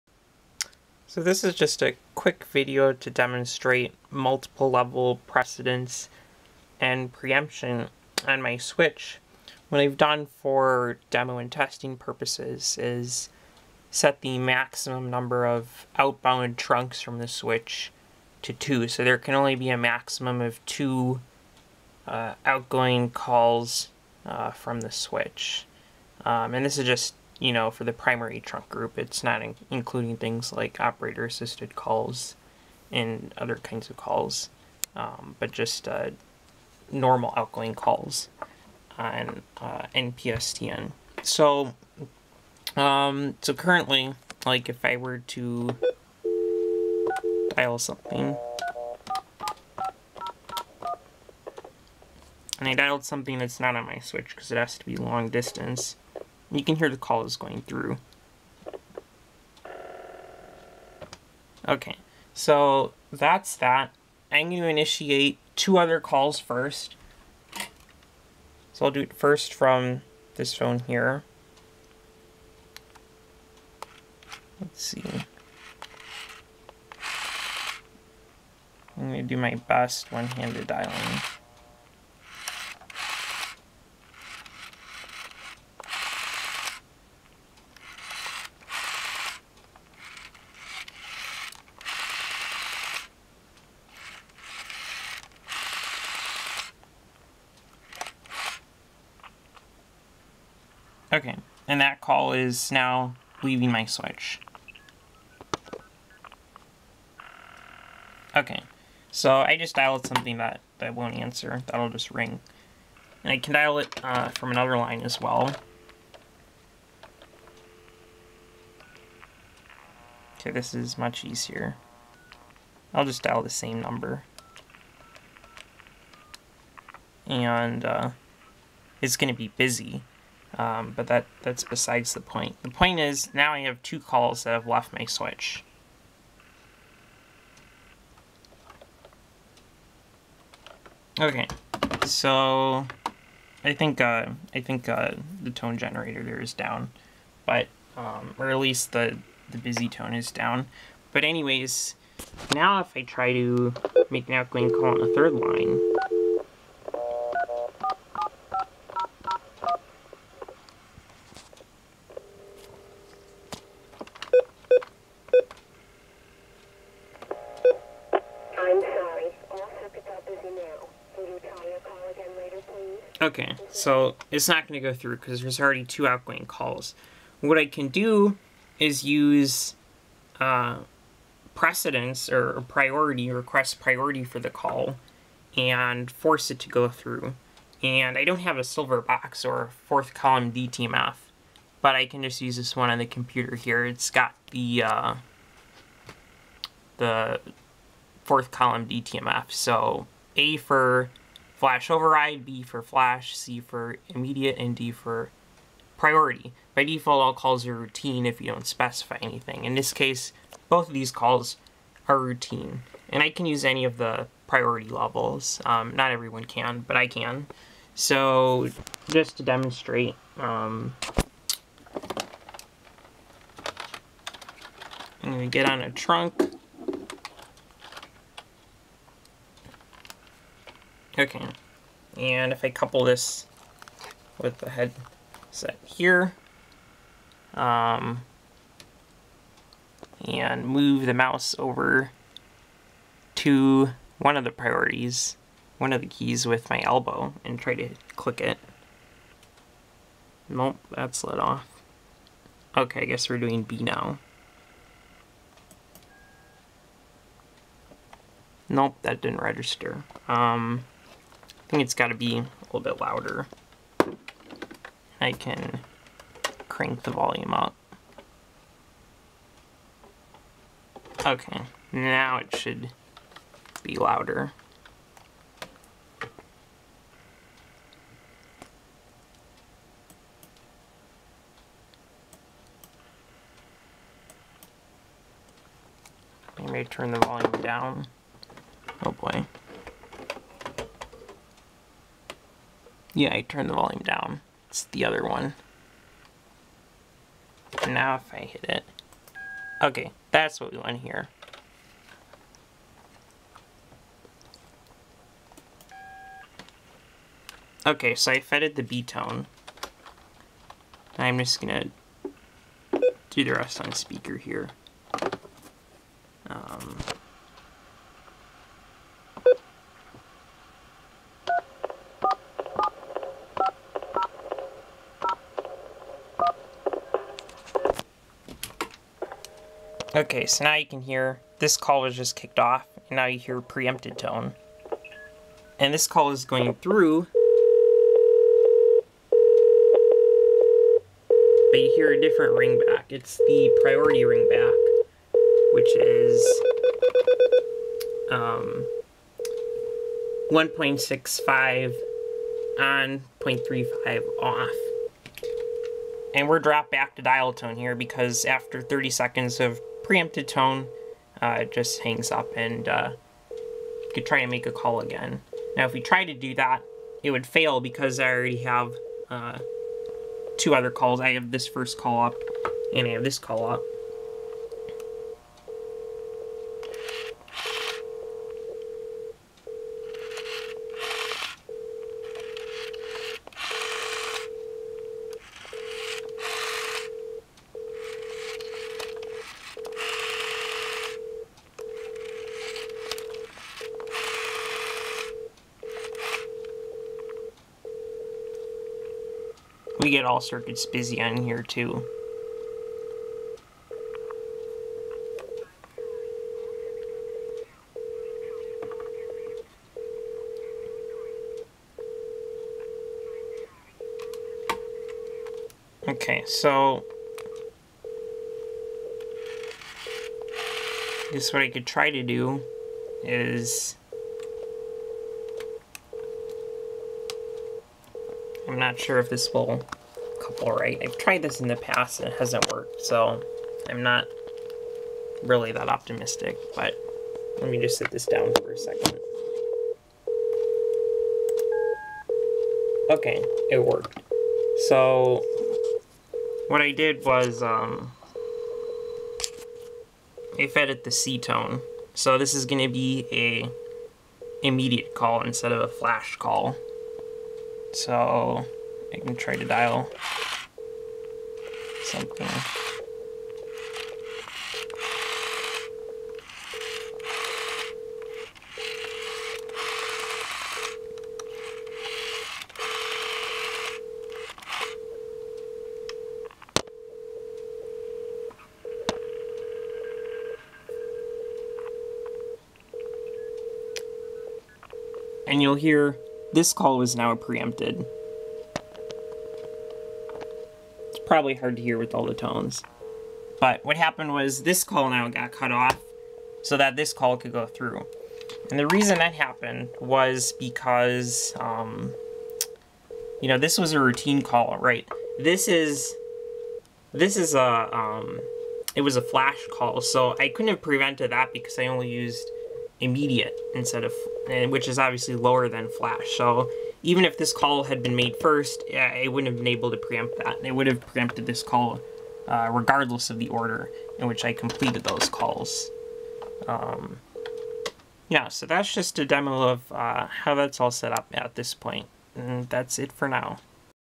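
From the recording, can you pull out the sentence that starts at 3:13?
It's got the uh, the fourth column DTMF.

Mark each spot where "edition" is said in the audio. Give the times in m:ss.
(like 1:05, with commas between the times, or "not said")
not said.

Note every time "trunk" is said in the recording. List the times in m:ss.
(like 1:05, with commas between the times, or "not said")
0:16, 0:28, 3:45.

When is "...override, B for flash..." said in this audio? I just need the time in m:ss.
3:21.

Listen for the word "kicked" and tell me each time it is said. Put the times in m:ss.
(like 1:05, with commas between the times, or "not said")
5:32.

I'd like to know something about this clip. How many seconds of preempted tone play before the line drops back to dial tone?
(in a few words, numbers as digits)
30.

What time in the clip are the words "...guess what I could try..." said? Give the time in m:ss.
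7:01.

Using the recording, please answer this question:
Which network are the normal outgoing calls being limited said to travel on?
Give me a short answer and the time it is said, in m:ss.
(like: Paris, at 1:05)
NPSTN, at 0:39.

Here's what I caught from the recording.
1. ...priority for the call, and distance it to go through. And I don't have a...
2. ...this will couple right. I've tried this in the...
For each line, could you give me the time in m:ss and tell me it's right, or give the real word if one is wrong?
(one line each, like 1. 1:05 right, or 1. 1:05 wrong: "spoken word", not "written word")
1. 3:03 wrong: "force", not "distance"
2. 7:09 right.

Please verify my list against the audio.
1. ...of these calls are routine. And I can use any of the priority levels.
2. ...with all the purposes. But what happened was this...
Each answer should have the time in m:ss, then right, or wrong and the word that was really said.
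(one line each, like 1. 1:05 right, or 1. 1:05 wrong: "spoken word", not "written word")
1. 3:30 right
2. 8:11 wrong: "tones", not "purposes".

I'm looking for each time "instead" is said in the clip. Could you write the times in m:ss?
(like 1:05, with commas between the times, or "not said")
7:35, 8:33.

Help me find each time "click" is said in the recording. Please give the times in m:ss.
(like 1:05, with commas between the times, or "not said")
4:08.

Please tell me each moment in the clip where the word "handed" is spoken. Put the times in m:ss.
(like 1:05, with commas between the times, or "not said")
1:20.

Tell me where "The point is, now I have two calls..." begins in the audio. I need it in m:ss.
2:12.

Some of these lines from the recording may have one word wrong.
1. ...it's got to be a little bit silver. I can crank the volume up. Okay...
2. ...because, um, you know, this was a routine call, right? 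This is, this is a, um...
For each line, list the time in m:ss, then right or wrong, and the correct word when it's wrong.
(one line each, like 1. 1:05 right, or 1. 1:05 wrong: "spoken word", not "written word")
1. 4:21 wrong: "louder", not "silver"
2. 8:20 right.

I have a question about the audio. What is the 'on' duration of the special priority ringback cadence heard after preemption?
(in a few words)
1.65.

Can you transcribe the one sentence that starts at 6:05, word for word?
Now if we try to do that, it would fail because I already have uh, two other calls.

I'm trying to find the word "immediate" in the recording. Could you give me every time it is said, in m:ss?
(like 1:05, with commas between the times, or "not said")
3:24, 7:34, 8:33.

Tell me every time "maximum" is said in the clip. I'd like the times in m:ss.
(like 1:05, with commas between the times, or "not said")
0:14, 0:19.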